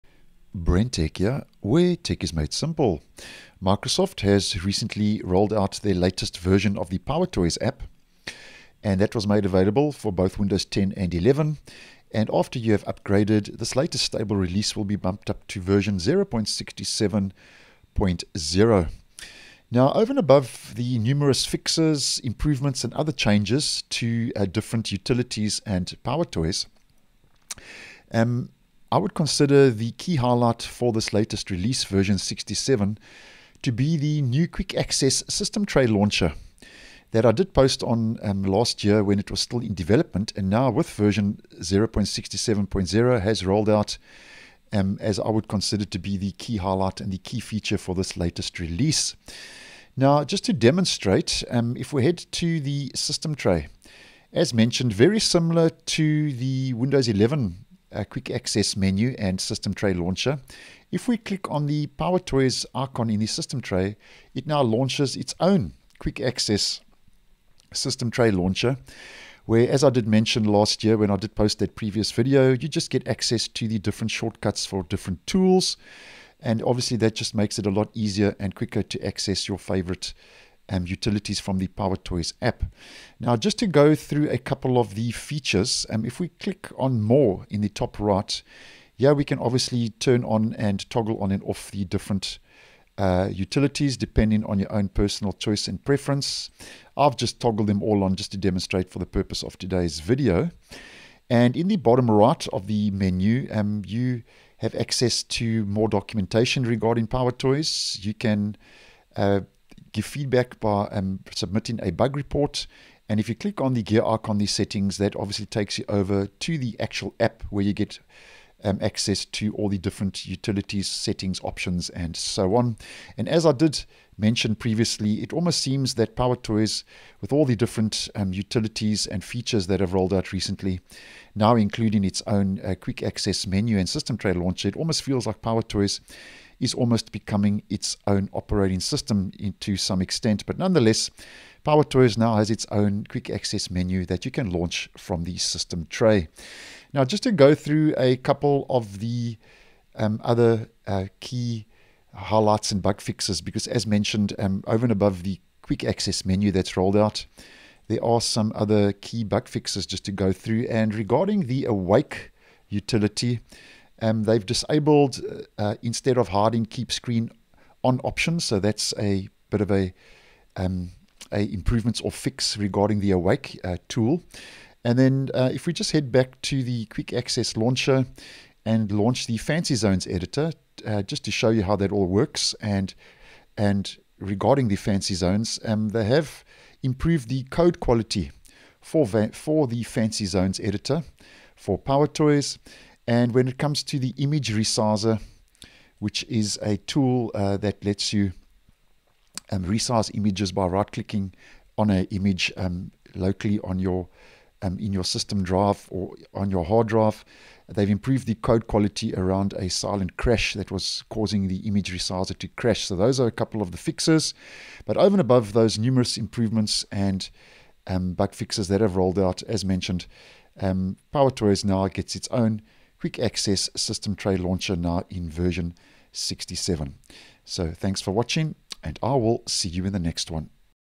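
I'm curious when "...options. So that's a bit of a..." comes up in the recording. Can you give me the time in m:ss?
2:48.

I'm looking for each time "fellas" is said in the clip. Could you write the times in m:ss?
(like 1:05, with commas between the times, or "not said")
not said.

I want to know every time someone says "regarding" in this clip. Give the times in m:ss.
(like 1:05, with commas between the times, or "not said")
1:46, 2:40, 2:52, 3:04.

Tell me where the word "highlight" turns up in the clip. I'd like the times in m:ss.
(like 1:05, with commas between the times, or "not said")
0:30, 0:46, 2:32.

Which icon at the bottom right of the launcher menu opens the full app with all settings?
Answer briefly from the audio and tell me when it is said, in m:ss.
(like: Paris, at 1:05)
gear icon, at 1:53.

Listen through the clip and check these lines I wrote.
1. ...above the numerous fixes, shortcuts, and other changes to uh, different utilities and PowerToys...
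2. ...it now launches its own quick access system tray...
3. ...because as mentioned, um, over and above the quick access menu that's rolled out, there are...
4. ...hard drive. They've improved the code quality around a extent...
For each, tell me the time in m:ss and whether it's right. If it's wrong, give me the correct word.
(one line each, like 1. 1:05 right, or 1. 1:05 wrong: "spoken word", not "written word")
1. 0:20 wrong: "improvements", not "shortcuts"
2. 1:04 right
3. 2:33 right
4. 3:26 wrong: "silent", not "extent".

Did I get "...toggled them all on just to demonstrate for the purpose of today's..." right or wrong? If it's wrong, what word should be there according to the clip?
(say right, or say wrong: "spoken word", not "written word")
right.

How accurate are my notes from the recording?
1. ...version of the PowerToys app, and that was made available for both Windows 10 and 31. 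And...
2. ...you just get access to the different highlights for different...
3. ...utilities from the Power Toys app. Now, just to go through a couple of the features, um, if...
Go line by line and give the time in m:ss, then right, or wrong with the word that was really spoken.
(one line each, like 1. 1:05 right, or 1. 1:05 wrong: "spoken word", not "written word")
1. 0:06 wrong: "11", not "31"
2. 1:12 wrong: "shortcuts", not "highlights"
3. 1:20 right.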